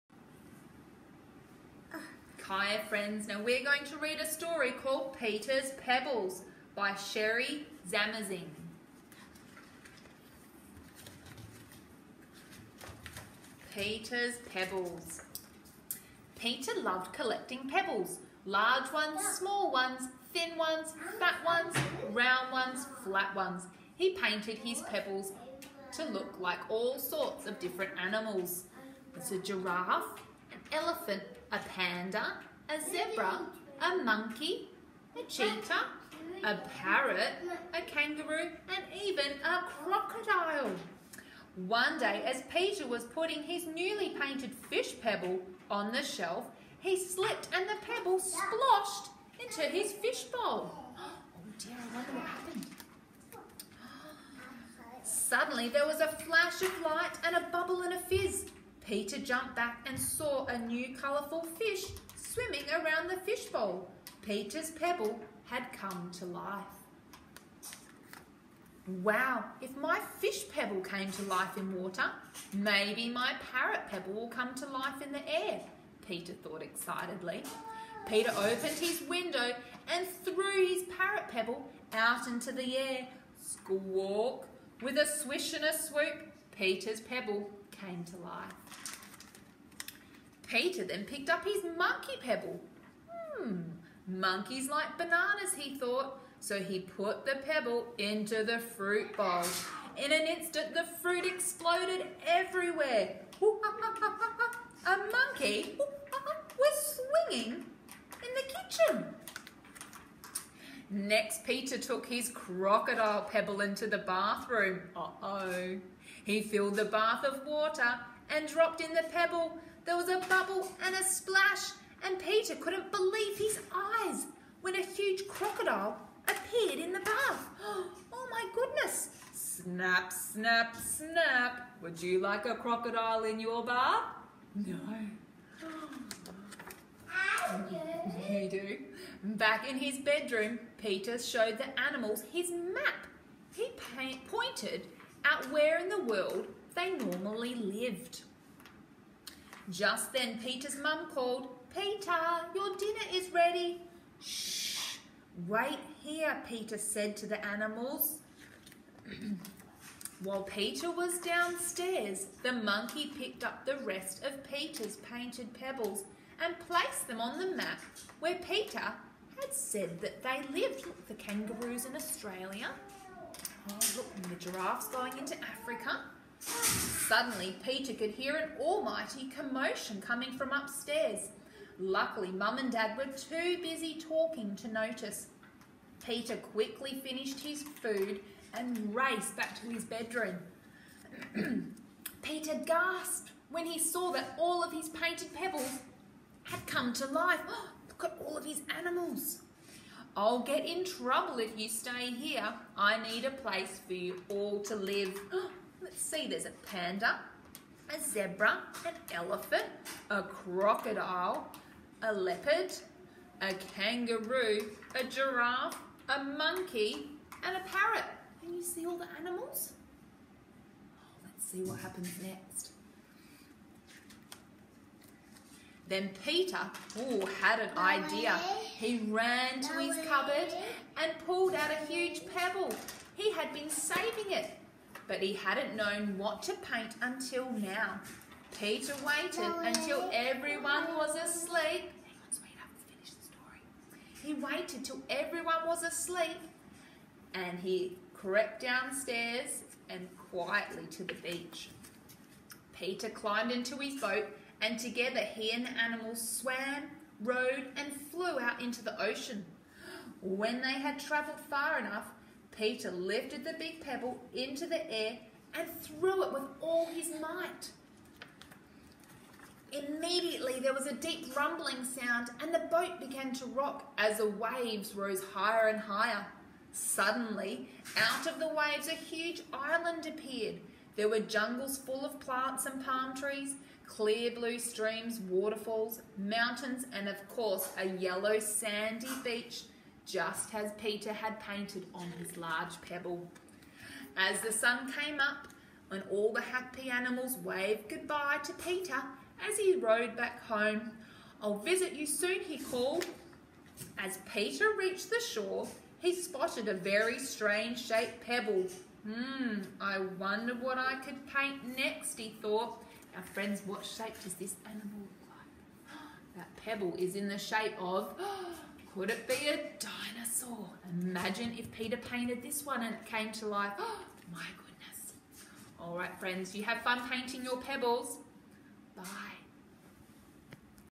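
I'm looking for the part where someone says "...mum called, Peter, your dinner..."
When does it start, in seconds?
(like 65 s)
150 s.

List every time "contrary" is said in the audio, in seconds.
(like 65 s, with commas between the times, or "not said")
not said.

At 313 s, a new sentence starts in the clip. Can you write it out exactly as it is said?
Now, friends, what shape does this animal look like?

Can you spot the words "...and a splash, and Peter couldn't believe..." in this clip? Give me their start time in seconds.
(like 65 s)
120 s.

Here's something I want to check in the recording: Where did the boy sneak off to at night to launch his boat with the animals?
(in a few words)
The beach.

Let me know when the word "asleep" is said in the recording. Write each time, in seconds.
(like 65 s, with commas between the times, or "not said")
241 s, 245 s.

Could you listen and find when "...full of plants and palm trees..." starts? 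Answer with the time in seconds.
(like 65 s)
281 s.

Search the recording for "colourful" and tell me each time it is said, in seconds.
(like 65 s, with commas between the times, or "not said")
60 s.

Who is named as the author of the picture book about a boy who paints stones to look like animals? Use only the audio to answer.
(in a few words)
Cherie Zamazing.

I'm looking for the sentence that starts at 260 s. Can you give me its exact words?
When they had travelled far enough, Peter lifted the big pebble into the air and threw it with all his might.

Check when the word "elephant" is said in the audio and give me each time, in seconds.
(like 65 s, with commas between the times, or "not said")
30 s, 209 s.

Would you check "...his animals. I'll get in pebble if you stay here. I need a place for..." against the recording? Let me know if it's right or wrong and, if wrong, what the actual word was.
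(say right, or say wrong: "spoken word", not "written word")
wrong: "trouble", not "pebble".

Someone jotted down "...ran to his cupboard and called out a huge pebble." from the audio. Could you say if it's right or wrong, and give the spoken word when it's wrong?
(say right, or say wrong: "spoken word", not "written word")
wrong: "pulled", not "called".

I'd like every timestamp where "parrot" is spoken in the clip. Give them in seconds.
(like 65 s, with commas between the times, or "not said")
36 s, 73 s, 80 s, 217 s.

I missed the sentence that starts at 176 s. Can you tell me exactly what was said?
Suddenly, Peter could hear an almighty commotion coming from upstairs.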